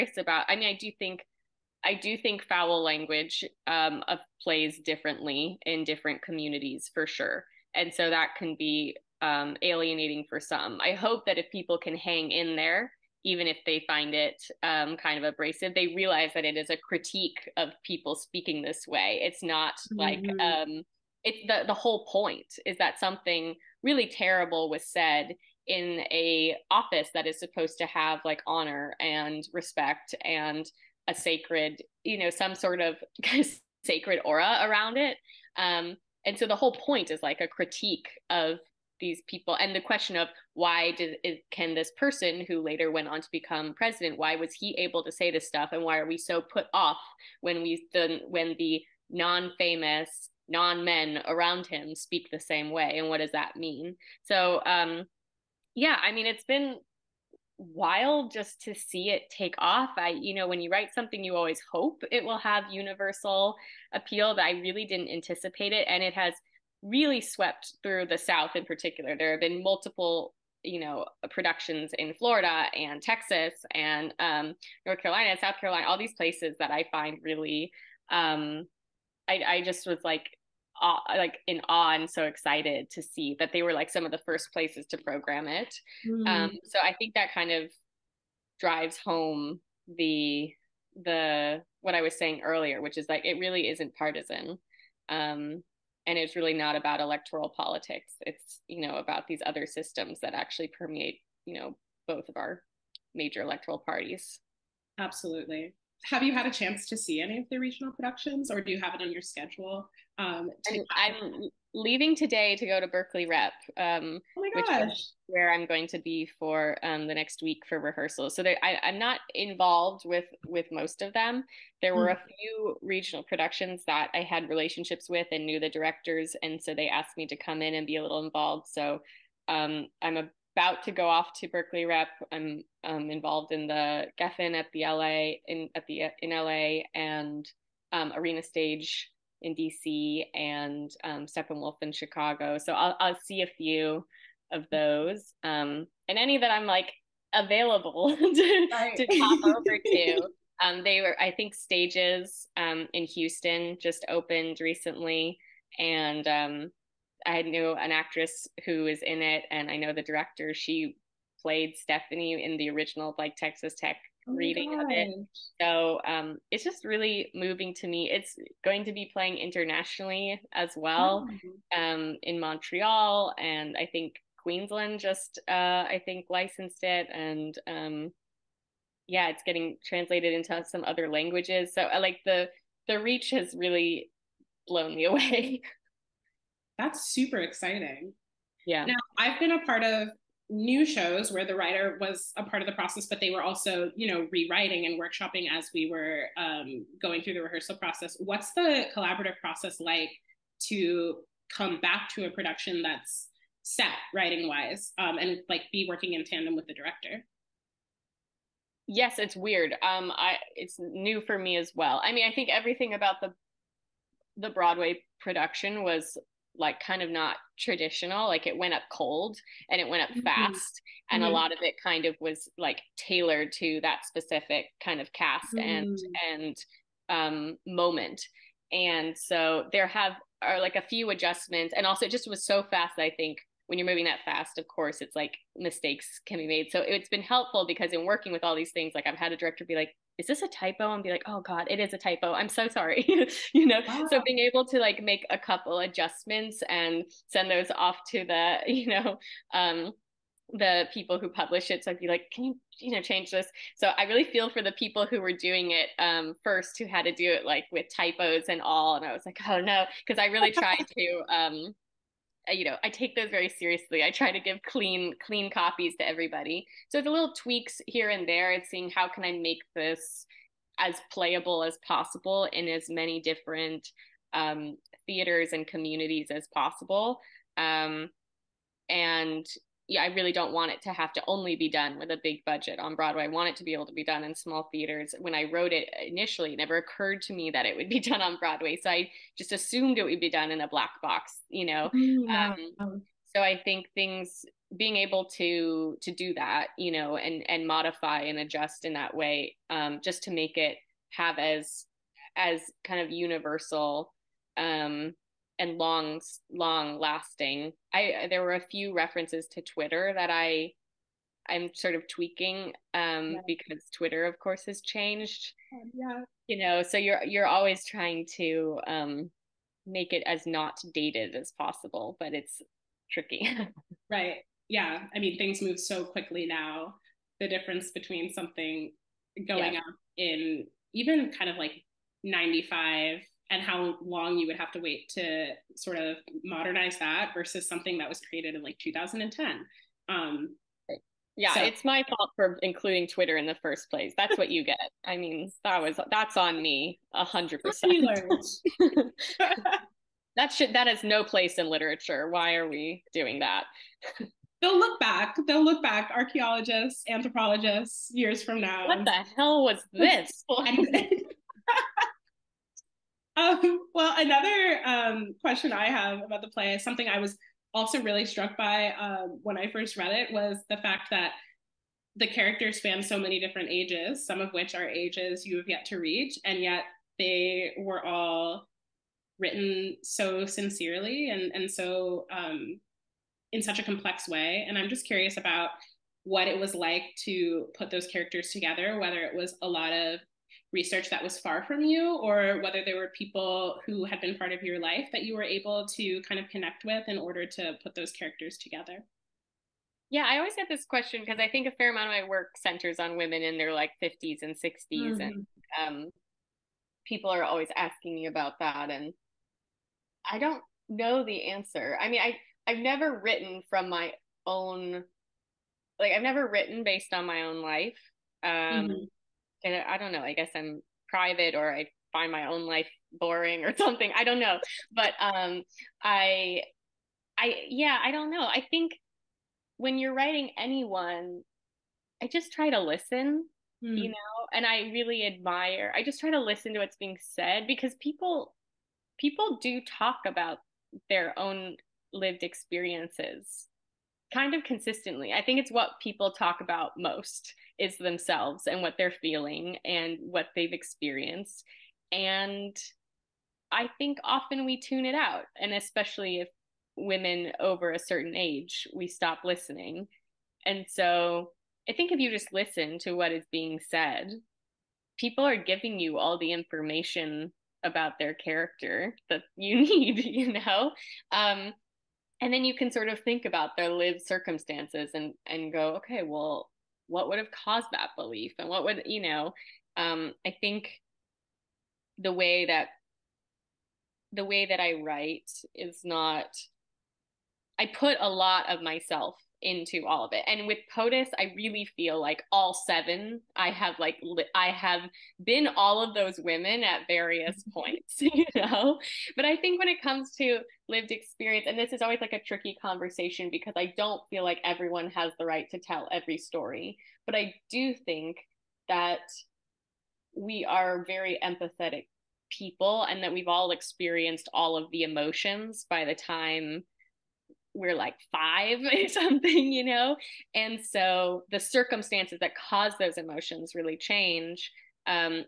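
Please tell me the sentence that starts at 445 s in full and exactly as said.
I think it's what people talk about most is themselves and what they're feeling and what they've experienced.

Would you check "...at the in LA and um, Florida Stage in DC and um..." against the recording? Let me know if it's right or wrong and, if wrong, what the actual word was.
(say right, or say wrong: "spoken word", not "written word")
wrong: "Arena", not "Florida".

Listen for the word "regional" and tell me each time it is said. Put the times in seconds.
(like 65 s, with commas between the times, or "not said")
107 s, 122 s.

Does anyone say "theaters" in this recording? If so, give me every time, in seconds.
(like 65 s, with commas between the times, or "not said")
275 s, 284 s.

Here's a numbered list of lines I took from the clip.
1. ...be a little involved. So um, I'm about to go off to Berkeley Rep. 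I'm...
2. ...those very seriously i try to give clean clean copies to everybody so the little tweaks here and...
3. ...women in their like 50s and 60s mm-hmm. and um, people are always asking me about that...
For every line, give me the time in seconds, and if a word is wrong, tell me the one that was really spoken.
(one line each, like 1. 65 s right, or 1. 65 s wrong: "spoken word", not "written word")
1. 127 s right
2. 263 s right
3. 403 s right.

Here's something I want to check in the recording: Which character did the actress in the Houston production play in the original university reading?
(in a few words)
Stephanie.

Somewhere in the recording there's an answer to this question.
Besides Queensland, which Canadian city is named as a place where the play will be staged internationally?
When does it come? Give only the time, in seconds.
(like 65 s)
172 s.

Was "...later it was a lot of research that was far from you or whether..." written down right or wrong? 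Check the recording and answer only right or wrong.
wrong.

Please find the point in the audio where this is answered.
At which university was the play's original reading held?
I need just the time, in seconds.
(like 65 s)
163 s.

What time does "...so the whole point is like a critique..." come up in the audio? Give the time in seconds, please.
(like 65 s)
36 s.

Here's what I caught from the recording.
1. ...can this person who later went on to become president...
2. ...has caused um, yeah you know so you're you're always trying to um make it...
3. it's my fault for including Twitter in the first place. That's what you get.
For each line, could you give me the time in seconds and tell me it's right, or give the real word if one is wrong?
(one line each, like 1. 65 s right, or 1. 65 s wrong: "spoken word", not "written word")
1. 41 s right
2. 314 s wrong: "changed", not "caused"
3. 341 s right.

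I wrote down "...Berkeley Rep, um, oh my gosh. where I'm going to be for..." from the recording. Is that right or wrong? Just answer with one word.
right.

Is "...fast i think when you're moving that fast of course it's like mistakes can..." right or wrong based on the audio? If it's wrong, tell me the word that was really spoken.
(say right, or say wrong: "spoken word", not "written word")
right.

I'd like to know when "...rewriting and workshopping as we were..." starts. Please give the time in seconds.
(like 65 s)
194 s.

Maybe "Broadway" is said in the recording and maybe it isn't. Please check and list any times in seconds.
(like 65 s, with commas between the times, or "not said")
214 s, 282 s, 288 s.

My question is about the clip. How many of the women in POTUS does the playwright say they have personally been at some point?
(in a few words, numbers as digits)
7.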